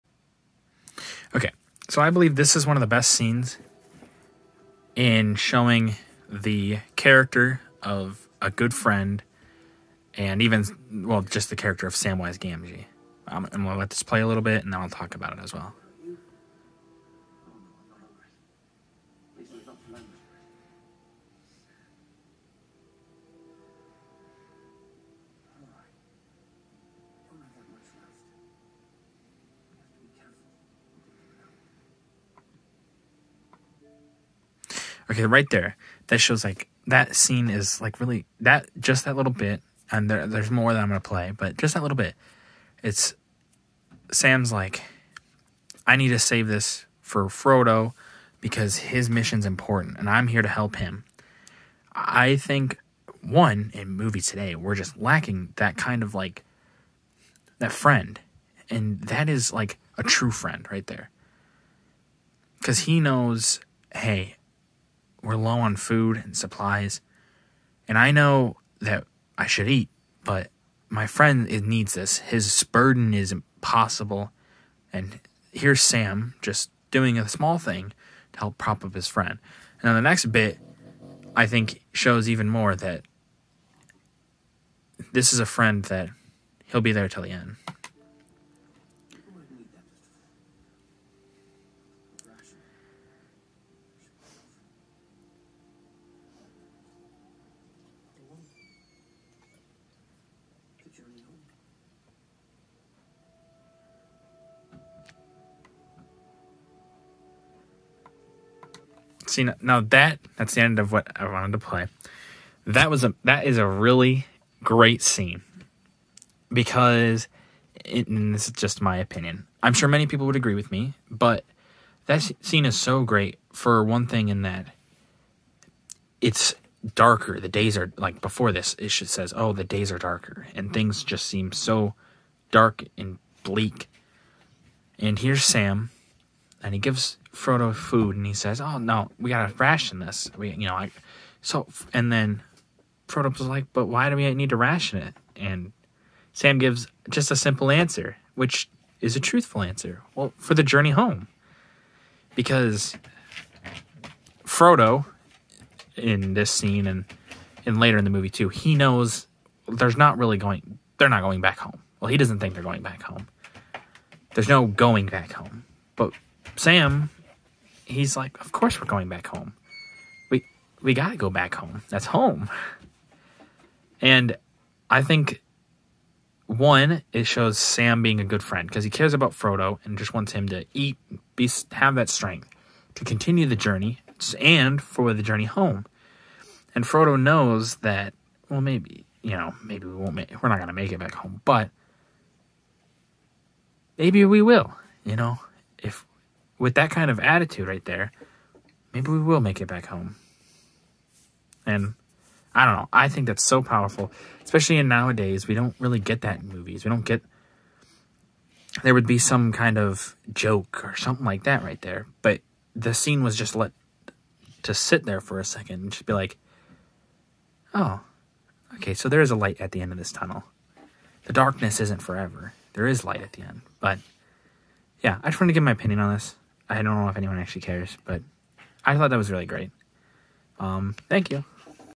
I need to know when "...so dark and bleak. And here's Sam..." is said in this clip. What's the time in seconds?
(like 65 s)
131 s.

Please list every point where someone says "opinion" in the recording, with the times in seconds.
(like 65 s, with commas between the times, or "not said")
118 s, 225 s.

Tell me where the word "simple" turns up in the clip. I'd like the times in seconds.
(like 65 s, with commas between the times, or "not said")
147 s.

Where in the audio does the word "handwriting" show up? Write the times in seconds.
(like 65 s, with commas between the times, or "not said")
not said.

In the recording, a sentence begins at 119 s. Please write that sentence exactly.
I'm sure many people would agree with me, but that scene is so great for one thing in that it's darker.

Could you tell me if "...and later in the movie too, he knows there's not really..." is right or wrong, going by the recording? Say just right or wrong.
right.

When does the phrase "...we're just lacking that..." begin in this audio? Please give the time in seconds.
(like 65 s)
54 s.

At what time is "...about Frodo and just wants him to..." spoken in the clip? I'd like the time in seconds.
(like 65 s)
179 s.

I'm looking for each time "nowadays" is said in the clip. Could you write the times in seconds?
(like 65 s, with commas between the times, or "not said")
204 s.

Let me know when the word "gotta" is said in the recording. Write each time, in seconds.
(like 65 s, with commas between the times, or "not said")
139 s, 170 s.